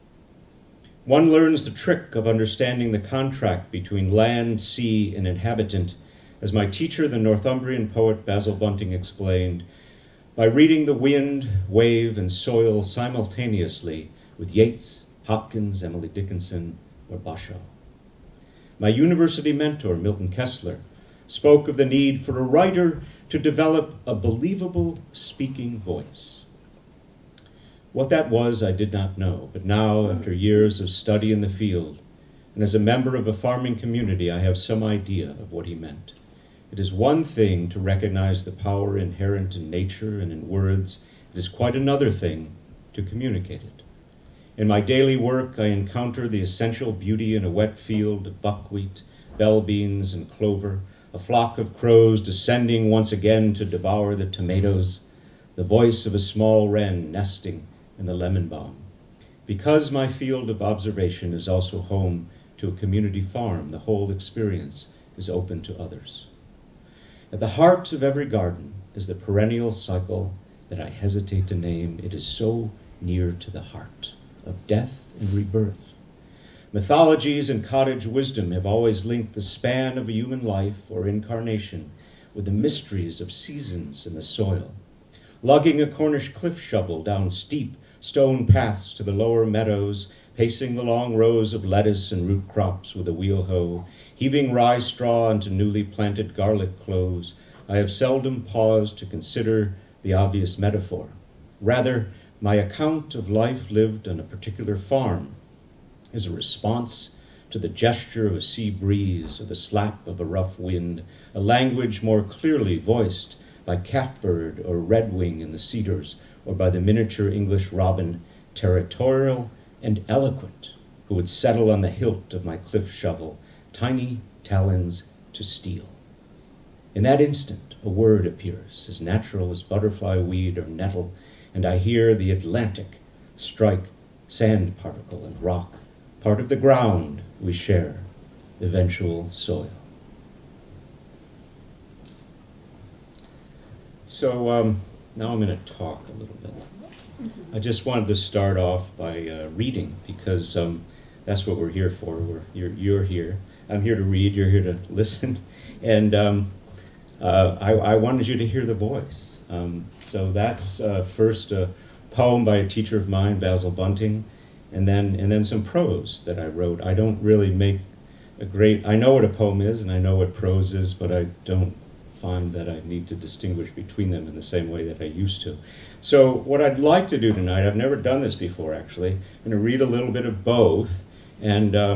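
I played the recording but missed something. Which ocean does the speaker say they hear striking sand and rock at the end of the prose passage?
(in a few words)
Atlantic.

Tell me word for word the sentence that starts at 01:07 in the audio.
At the heart of every garden is the perennial cycle that I hesitate to name.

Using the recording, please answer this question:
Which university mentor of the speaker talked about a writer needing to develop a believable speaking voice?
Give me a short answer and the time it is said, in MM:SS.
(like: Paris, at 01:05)
Milton Kessler, at 00:19.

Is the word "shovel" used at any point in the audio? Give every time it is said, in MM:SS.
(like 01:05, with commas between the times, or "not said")
01:26, 02:02.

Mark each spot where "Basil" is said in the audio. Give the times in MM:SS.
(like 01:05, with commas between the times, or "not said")
00:08, 02:43.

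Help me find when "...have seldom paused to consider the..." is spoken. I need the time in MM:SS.
01:37.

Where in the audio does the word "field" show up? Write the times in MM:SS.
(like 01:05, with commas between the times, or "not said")
00:31, 00:47, 01:00.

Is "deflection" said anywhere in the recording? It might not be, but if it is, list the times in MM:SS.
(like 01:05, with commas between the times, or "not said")
not said.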